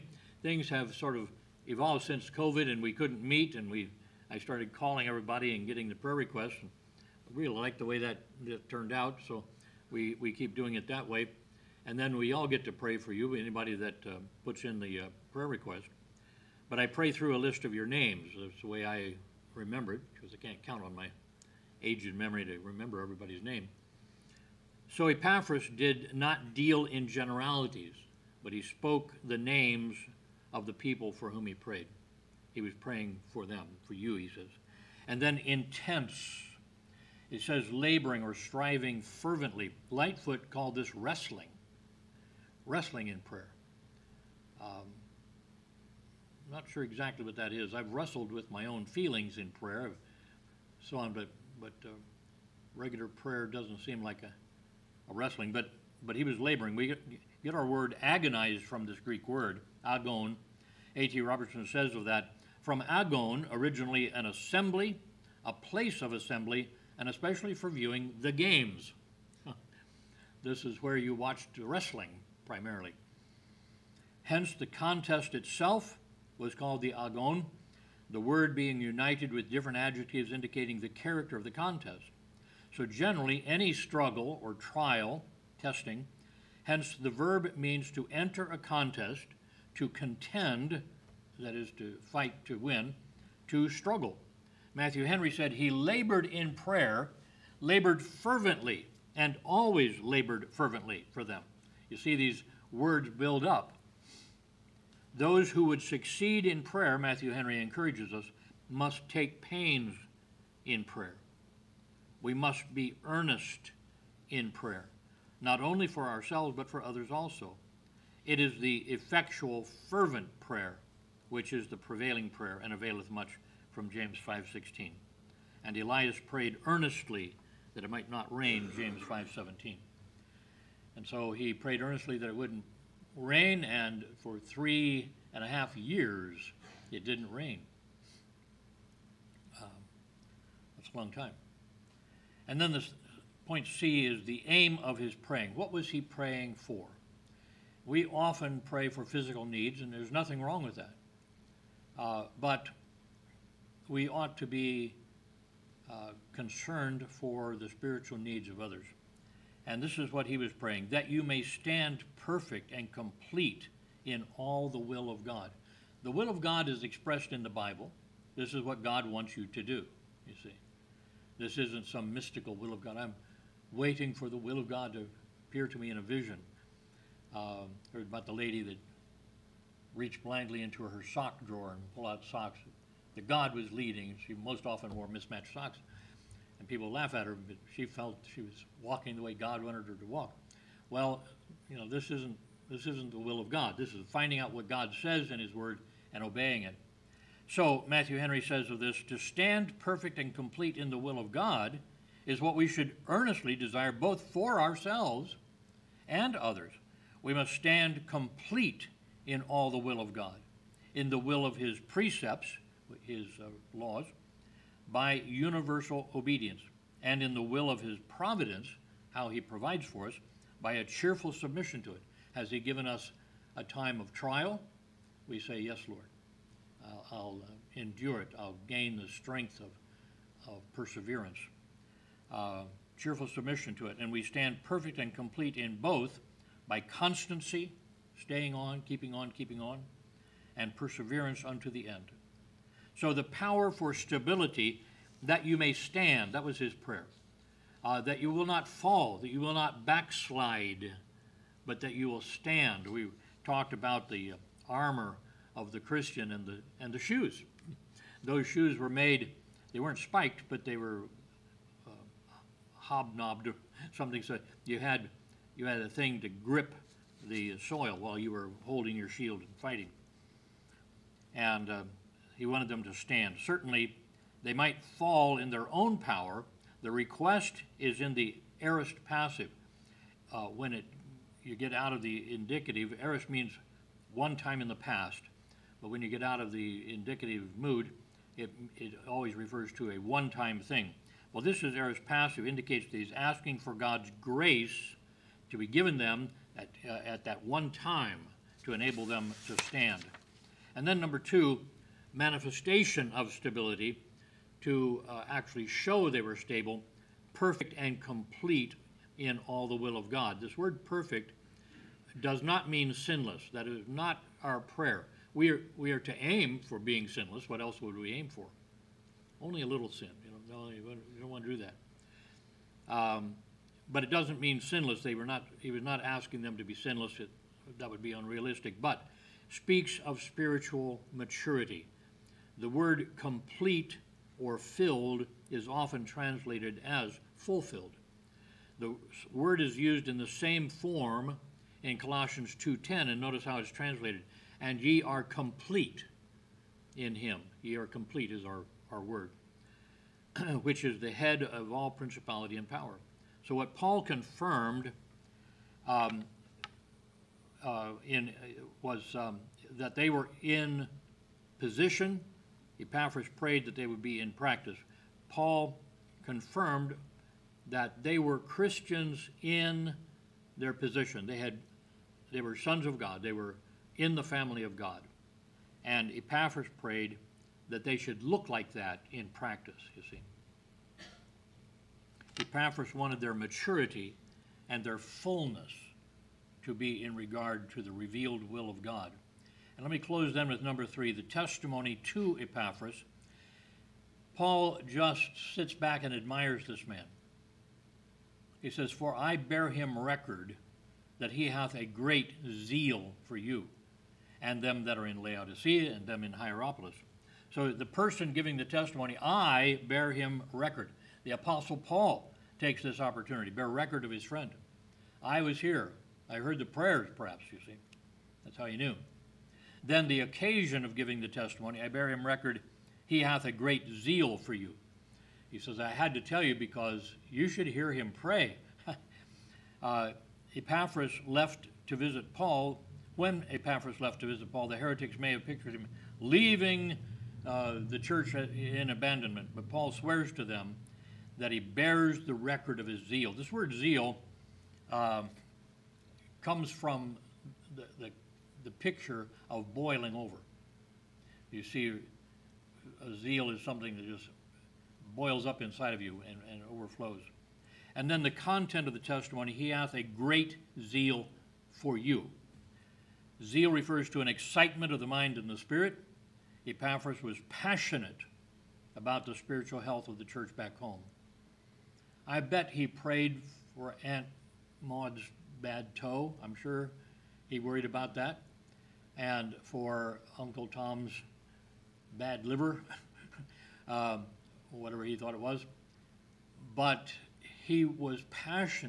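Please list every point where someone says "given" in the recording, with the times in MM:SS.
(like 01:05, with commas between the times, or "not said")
03:42, 04:55.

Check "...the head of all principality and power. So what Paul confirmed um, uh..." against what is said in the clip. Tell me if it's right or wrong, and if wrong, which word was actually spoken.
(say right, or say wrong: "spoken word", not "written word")
right.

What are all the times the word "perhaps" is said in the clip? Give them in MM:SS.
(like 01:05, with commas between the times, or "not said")
06:57.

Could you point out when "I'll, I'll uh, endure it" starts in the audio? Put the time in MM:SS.
03:46.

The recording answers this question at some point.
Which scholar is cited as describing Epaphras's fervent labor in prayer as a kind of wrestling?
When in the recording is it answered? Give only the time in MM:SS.
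00:39.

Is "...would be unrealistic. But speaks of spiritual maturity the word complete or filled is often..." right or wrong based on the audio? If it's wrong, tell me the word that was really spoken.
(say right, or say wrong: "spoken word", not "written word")
right.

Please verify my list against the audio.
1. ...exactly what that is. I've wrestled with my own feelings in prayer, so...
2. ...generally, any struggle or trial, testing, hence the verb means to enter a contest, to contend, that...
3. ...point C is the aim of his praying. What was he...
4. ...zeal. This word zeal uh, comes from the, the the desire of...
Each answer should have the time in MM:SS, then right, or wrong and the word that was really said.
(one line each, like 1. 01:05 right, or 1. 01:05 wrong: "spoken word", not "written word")
1. 00:46 right
2. 01:22 right
3. 02:23 right
4. 07:23 wrong: "picture", not "desire".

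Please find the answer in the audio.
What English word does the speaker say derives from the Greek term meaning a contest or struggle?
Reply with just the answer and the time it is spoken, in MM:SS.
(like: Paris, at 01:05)
agonized, at 00:58.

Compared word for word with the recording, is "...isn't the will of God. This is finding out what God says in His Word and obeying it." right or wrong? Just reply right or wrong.
right.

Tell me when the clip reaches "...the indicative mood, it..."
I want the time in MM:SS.
04:46.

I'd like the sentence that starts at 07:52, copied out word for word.
I bet he prayed for Aunt Maud's bad toe.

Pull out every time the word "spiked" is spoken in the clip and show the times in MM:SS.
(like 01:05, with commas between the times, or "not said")
04:19.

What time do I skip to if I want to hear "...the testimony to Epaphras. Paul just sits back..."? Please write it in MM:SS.
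06:31.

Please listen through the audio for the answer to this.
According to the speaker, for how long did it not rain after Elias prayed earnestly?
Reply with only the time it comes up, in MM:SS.
02:14.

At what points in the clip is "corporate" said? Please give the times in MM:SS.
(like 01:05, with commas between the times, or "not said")
not said.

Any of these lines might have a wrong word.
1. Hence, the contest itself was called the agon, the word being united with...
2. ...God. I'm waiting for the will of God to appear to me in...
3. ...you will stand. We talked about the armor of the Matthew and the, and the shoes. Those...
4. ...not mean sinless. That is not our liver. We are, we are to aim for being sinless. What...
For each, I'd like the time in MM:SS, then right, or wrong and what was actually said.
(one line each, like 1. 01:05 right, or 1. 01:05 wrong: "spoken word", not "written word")
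1. 01:14 right
2. 02:52 right
3. 04:11 wrong: "Christian", not "Matthew"
4. 05:12 wrong: "prayer", not "liver".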